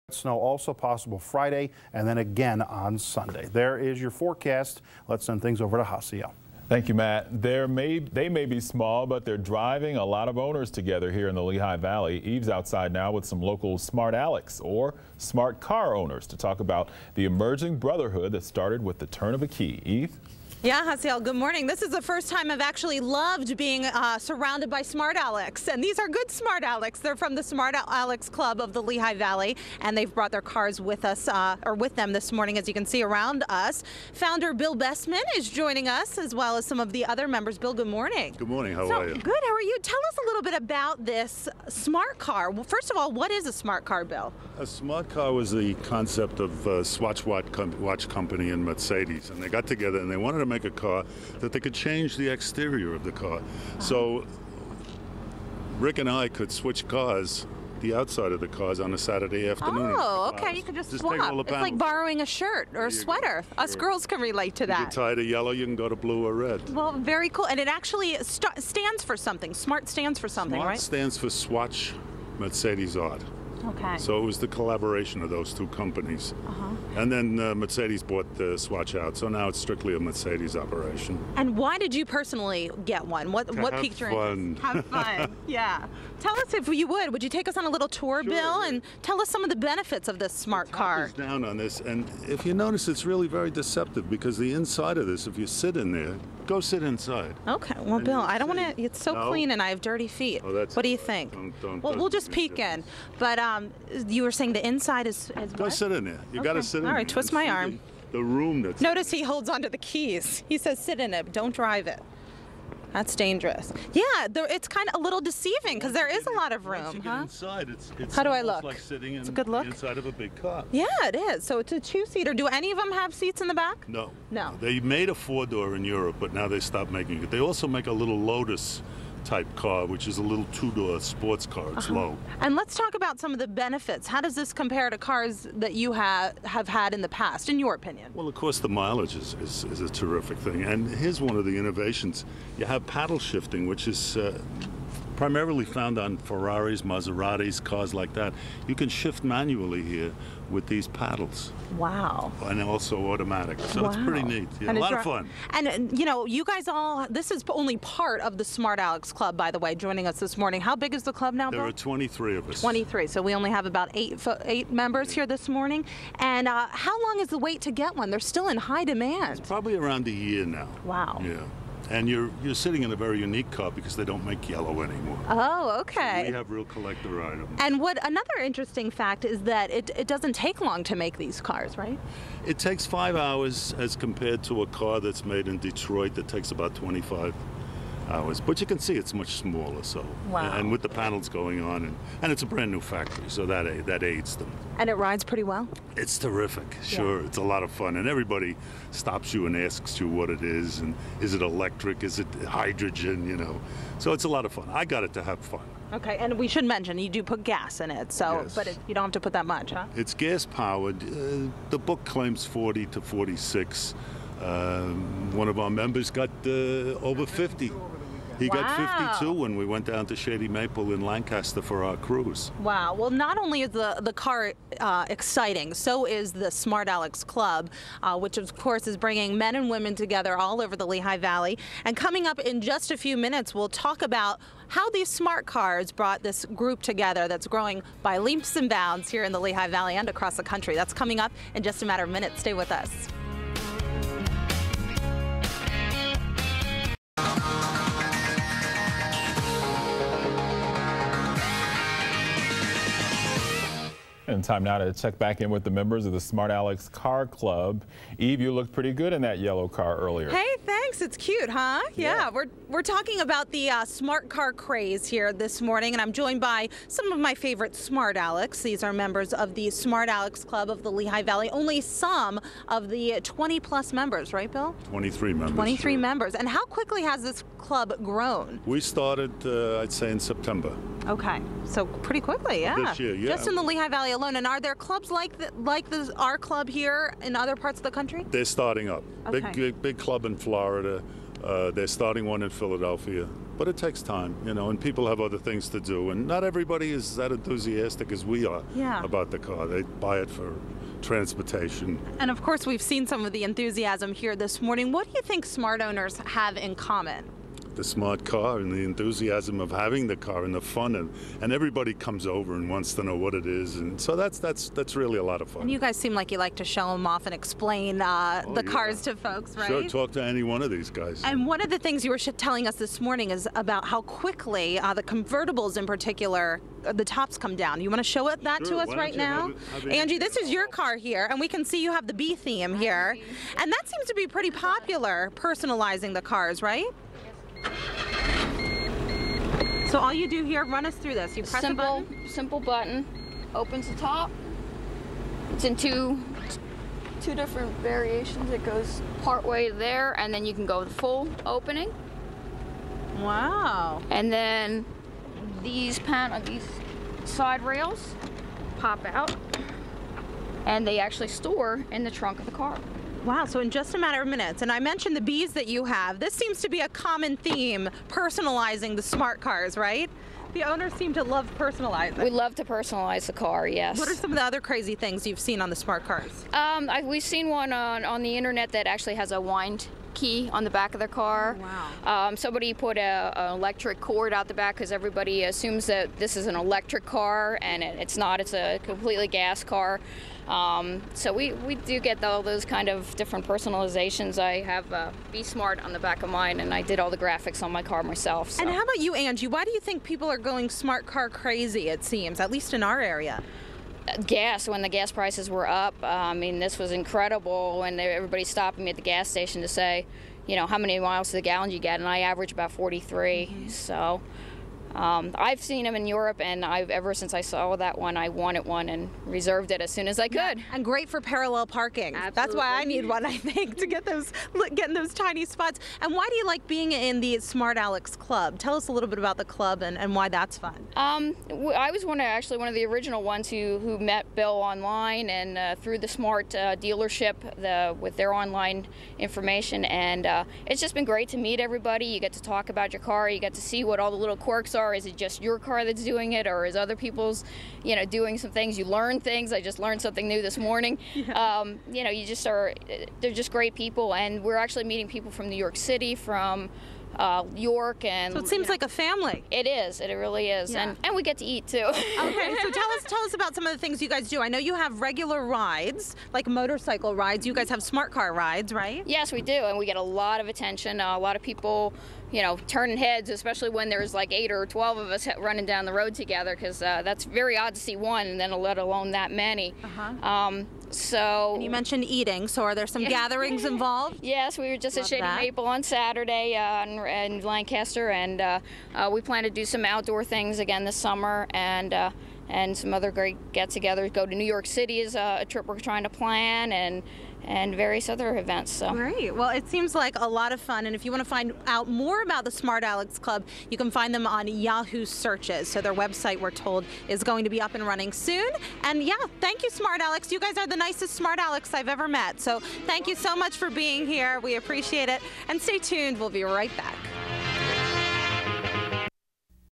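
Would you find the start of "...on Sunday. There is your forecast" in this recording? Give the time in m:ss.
0:02.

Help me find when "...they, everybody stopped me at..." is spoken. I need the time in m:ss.
6:47.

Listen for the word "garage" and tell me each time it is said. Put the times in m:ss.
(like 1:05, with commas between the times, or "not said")
not said.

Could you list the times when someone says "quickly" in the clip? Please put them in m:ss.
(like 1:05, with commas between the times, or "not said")
4:36, 4:42, 5:24.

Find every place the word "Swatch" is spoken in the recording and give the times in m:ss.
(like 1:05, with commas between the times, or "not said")
0:46, 1:11, 1:18.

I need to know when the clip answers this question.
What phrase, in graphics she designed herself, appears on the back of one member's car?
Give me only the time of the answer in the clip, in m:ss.
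6:35.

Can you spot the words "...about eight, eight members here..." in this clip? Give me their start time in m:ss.
2:43.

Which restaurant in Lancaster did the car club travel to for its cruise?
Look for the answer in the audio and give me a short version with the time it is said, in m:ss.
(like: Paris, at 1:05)
Shady Maple, at 3:40.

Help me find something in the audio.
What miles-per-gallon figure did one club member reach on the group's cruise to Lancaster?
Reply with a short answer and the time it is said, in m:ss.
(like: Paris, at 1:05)
52, at 3:39.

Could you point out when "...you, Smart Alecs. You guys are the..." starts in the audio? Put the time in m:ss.
8:29.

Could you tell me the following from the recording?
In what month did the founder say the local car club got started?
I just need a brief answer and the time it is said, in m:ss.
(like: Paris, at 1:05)
September, at 4:40.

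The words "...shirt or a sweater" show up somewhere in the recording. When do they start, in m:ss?
1:02.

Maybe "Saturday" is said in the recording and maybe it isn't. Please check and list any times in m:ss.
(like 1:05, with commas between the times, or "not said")
0:58, 8:05.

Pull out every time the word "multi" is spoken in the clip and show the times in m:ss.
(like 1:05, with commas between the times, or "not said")
not said.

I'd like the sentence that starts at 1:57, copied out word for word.
Inside, it's, it's How do I look?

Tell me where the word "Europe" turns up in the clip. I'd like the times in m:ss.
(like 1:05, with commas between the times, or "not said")
2:05, 6:56.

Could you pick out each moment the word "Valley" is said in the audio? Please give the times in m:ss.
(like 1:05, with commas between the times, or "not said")
0:11, 0:29, 3:51, 3:59, 4:31, 4:43.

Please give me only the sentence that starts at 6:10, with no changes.
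The owners seem to love personalizing.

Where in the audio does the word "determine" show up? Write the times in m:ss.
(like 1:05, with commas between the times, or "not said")
not said.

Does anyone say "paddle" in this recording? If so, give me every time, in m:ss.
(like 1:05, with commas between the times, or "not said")
2:22, 2:30.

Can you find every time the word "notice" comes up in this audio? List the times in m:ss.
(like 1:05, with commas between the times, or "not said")
1:32, 1:48.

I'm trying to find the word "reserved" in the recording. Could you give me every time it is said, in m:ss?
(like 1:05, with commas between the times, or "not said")
6:59.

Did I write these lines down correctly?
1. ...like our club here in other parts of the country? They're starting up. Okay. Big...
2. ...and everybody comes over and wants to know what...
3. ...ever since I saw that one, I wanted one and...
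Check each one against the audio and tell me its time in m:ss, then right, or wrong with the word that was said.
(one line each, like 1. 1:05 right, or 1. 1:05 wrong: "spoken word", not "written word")
1. 4:45 right
2. 5:11 right
3. 6:56 right.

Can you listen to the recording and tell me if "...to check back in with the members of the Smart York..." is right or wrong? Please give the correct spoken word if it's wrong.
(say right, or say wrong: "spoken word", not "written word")
wrong: "Alecs", not "York".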